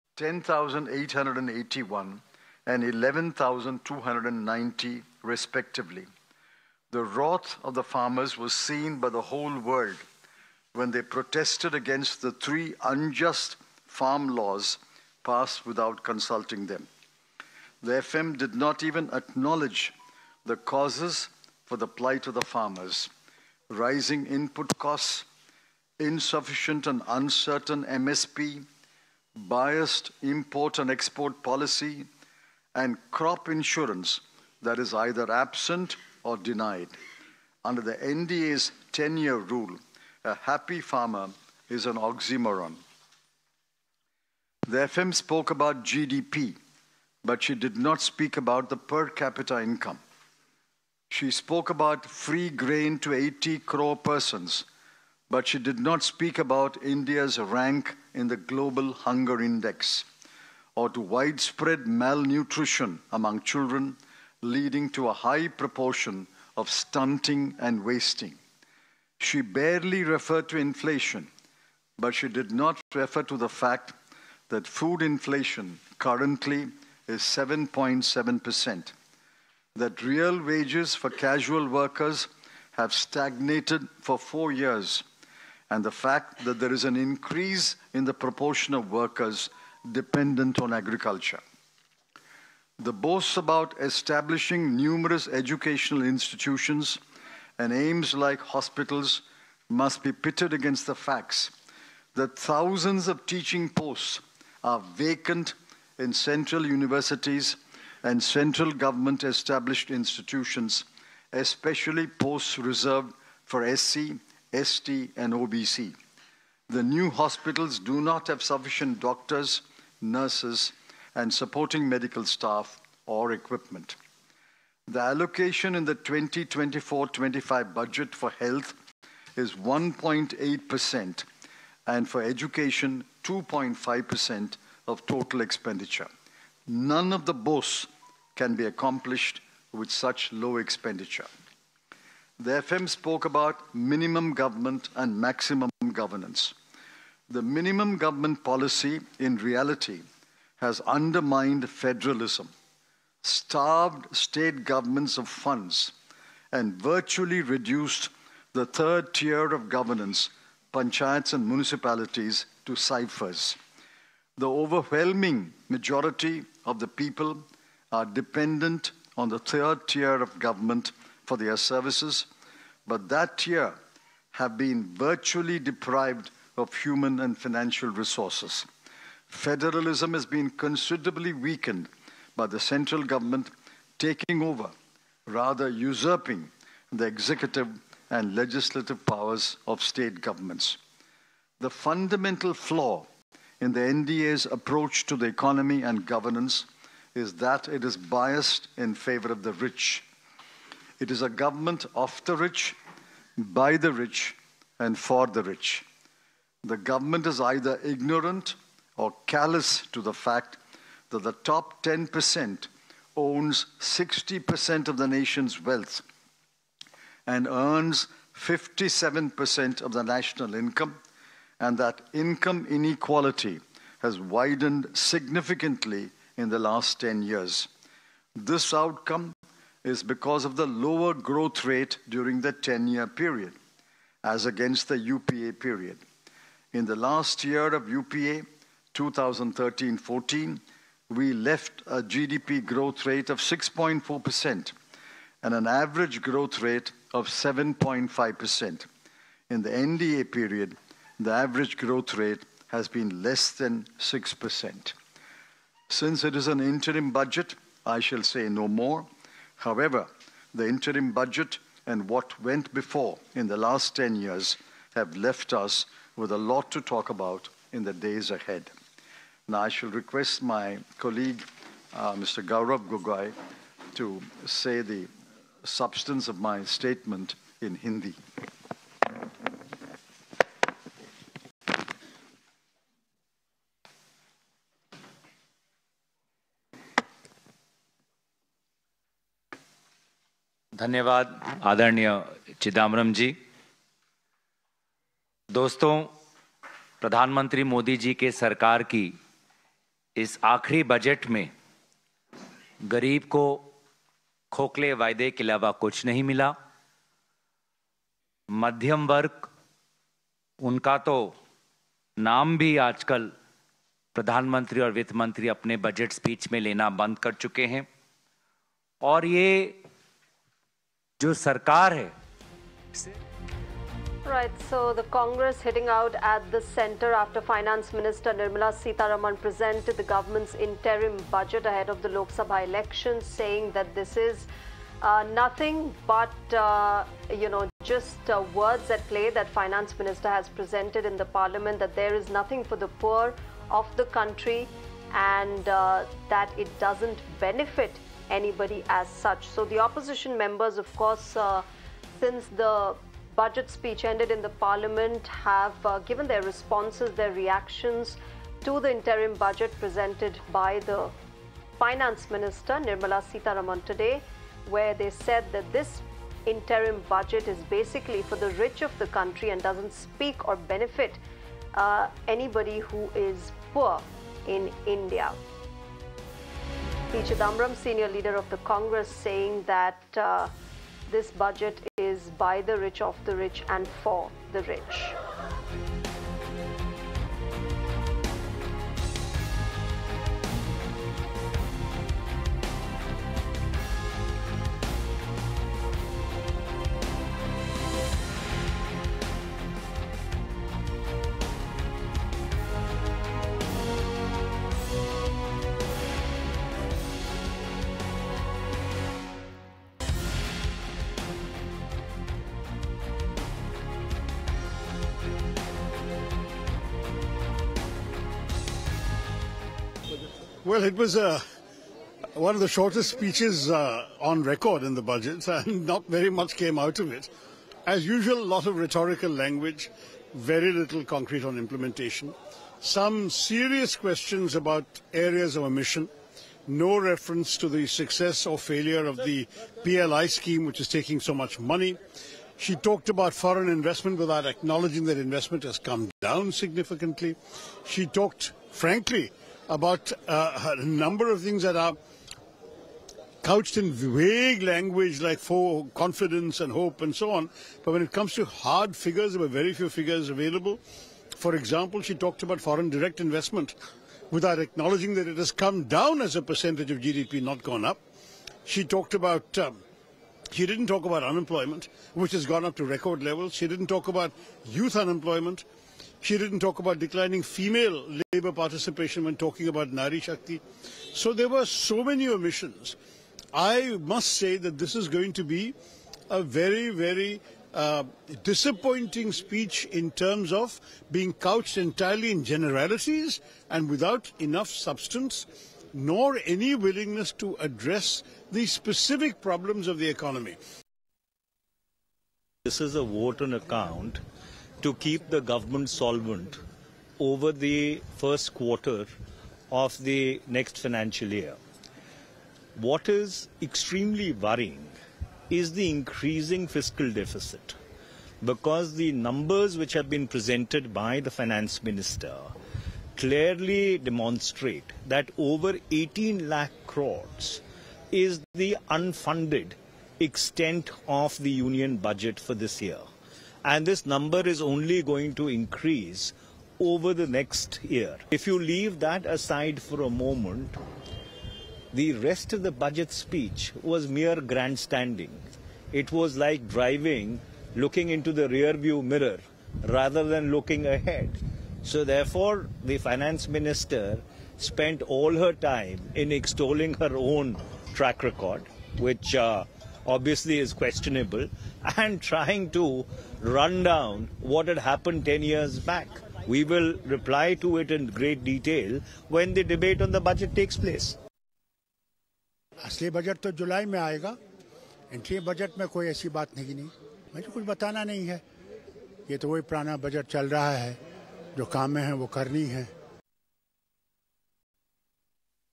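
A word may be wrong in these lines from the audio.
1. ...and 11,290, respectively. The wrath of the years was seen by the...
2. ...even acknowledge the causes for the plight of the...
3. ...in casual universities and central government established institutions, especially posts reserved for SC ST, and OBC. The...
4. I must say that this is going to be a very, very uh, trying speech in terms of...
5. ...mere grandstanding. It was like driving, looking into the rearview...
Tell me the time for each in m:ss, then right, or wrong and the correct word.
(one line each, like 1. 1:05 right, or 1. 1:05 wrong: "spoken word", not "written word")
1. 0:02 wrong: "farmers", not "years"
2. 0:18 right
3. 1:45 wrong: "central", not "casual"
4. 8:03 wrong: "disappointing", not "trying"
5. 9:04 right.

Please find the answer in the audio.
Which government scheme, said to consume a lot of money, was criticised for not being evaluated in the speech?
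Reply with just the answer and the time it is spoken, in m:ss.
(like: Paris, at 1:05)
PLI scheme, at 7:19.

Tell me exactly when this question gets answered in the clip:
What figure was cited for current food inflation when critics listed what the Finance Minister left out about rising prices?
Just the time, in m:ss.
1:17.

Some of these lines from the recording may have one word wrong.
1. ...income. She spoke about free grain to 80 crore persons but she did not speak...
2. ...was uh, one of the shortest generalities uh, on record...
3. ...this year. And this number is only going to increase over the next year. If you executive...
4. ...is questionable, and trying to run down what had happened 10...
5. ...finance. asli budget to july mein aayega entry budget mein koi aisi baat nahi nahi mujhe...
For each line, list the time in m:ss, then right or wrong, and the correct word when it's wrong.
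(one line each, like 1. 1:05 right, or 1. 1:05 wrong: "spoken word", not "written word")
1. 0:49 right
2. 7:00 wrong: "speeches", not "generalities"
3. 8:52 wrong: "leave", not "executive"
4. 9:20 right
5. 9:30 wrong: "place", not "finance".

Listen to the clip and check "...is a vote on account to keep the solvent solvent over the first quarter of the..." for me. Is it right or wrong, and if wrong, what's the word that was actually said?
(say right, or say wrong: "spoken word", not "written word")
wrong: "government", not "solvent".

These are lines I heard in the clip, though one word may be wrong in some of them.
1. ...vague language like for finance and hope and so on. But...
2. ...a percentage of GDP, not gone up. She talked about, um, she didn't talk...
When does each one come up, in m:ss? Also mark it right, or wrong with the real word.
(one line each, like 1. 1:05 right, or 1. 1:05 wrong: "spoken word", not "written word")
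1. 7:33 wrong: "confidence", not "finance"
2. 7:46 right.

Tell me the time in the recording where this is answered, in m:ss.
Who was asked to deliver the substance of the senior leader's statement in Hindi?
4:32.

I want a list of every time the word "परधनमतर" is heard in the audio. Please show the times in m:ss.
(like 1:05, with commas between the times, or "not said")
4:57, 5:14.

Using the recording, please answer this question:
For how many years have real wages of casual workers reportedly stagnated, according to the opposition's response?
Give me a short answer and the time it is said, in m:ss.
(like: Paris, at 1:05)
4, at 1:24.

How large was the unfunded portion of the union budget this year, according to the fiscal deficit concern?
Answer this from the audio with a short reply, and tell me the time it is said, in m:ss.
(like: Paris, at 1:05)
Over 18 lakh crore, at 8:45.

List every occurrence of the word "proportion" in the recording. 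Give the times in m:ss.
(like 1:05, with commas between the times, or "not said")
1:05, 1:28.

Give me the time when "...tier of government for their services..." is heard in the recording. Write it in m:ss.
2:49.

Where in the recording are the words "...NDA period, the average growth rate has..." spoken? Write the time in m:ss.
4:09.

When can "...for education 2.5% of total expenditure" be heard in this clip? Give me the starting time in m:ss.
2:12.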